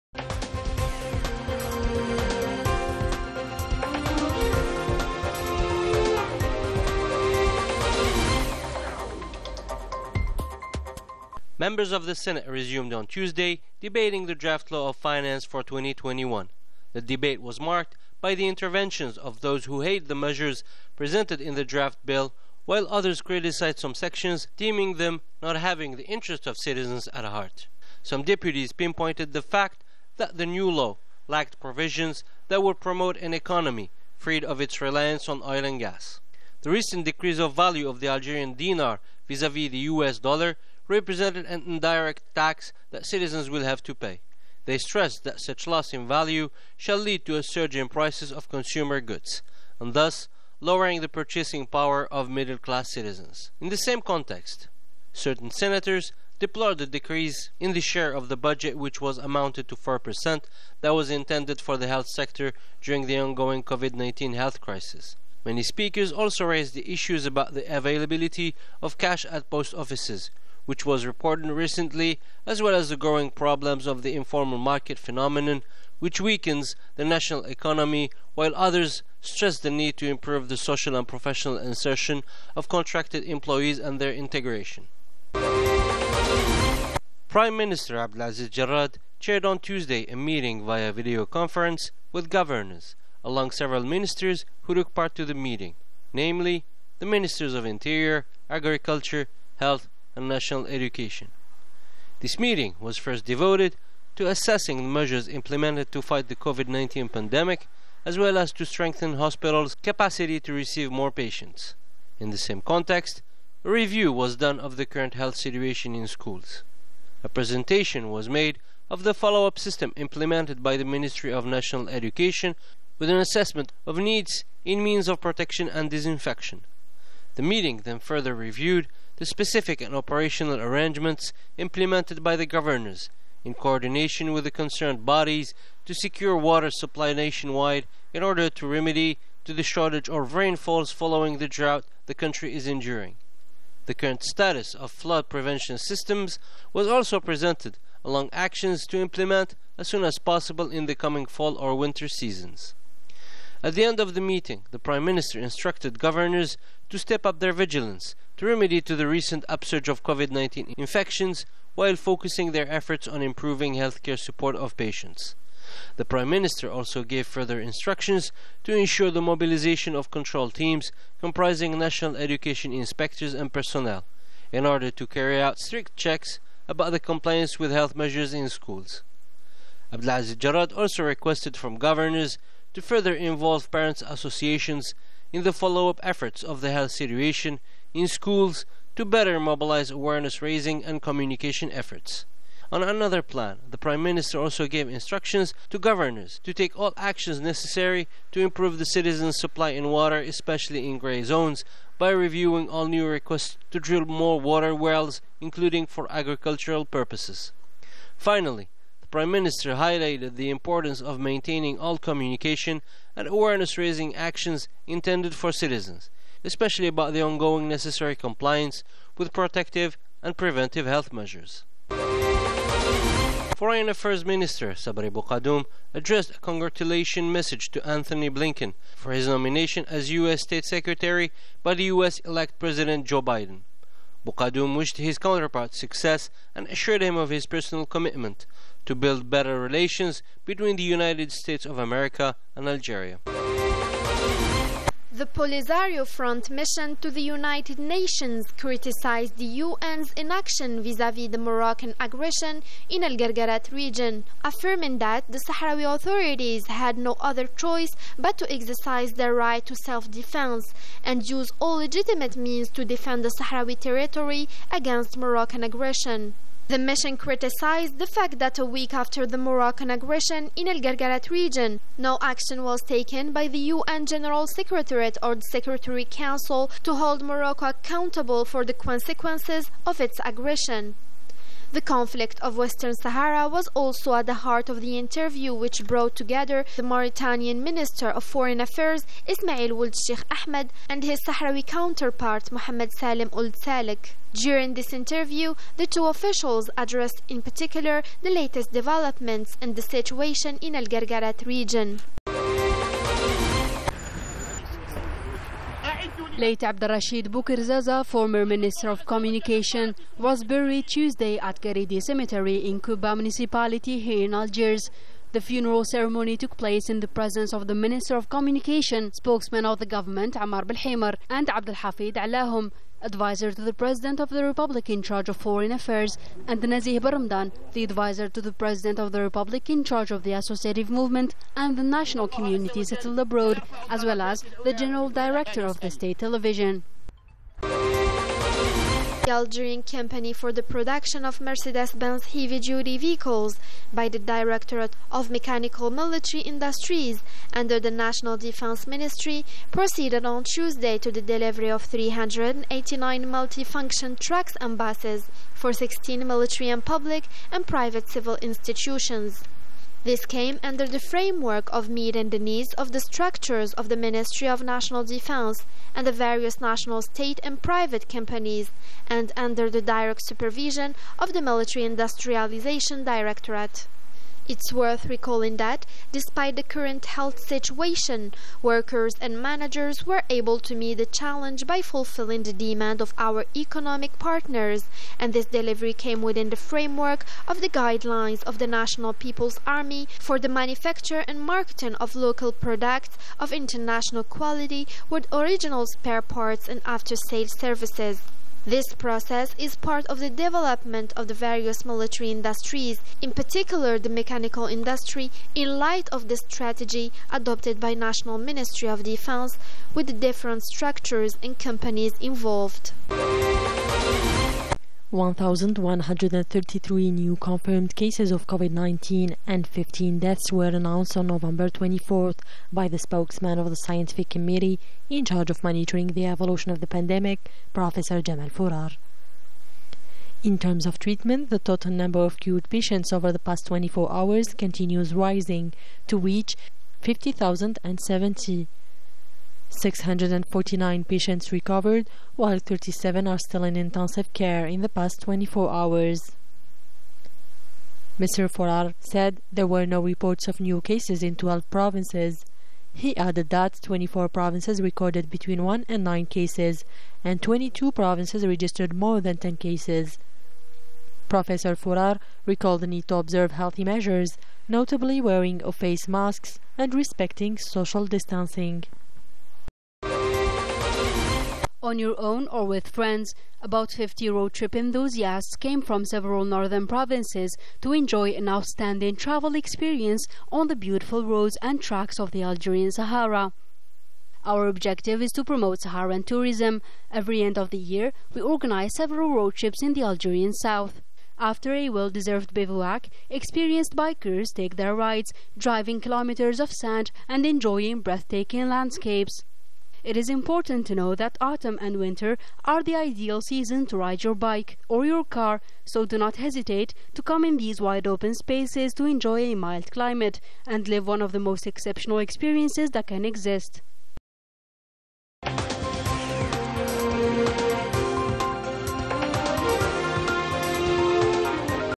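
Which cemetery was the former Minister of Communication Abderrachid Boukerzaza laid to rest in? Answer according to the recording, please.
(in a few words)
Garidi Cemetery.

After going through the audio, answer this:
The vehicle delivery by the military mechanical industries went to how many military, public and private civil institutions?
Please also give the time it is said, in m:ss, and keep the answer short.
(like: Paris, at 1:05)
16, at 5:55.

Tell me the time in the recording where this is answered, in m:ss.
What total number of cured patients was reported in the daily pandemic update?
7:17.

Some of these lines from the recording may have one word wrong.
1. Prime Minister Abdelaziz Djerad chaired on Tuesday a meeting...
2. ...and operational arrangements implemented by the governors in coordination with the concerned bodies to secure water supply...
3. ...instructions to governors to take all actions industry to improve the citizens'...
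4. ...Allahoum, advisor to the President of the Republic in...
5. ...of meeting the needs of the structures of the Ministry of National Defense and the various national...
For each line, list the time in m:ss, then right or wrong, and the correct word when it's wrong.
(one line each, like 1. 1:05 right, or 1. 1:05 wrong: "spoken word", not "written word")
1. 1:27 right
2. 2:09 right
3. 3:14 wrong: "necessary", not "industry"
4. 5:22 right
5. 6:01 right.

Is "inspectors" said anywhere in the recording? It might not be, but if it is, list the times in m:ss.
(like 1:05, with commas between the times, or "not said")
2:52.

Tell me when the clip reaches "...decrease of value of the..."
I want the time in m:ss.
0:37.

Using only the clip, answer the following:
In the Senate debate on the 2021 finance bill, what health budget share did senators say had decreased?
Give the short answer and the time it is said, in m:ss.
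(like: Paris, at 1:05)
4%, at 0:59.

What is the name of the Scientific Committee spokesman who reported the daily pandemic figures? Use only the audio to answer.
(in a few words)
Jamal Fourar.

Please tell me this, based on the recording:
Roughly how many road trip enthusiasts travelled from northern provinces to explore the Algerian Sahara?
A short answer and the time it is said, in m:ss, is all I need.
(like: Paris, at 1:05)
50, at 7:53.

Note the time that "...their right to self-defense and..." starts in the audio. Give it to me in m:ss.
4:19.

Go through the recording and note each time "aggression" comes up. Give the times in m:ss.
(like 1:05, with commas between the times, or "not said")
4:11, 4:25, 4:29, 4:40.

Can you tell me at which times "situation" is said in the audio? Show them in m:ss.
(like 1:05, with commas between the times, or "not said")
1:55, 3:06, 4:59, 6:17.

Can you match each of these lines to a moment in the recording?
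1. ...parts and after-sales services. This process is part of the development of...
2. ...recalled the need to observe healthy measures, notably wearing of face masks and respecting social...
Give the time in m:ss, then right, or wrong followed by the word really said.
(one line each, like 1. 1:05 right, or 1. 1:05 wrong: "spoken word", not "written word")
1. 6:36 right
2. 7:42 right.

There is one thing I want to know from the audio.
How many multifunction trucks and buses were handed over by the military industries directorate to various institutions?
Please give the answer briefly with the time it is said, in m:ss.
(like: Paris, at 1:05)
389, at 5:51.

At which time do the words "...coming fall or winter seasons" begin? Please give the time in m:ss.
2:30.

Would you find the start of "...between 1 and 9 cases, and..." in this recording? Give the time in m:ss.
7:35.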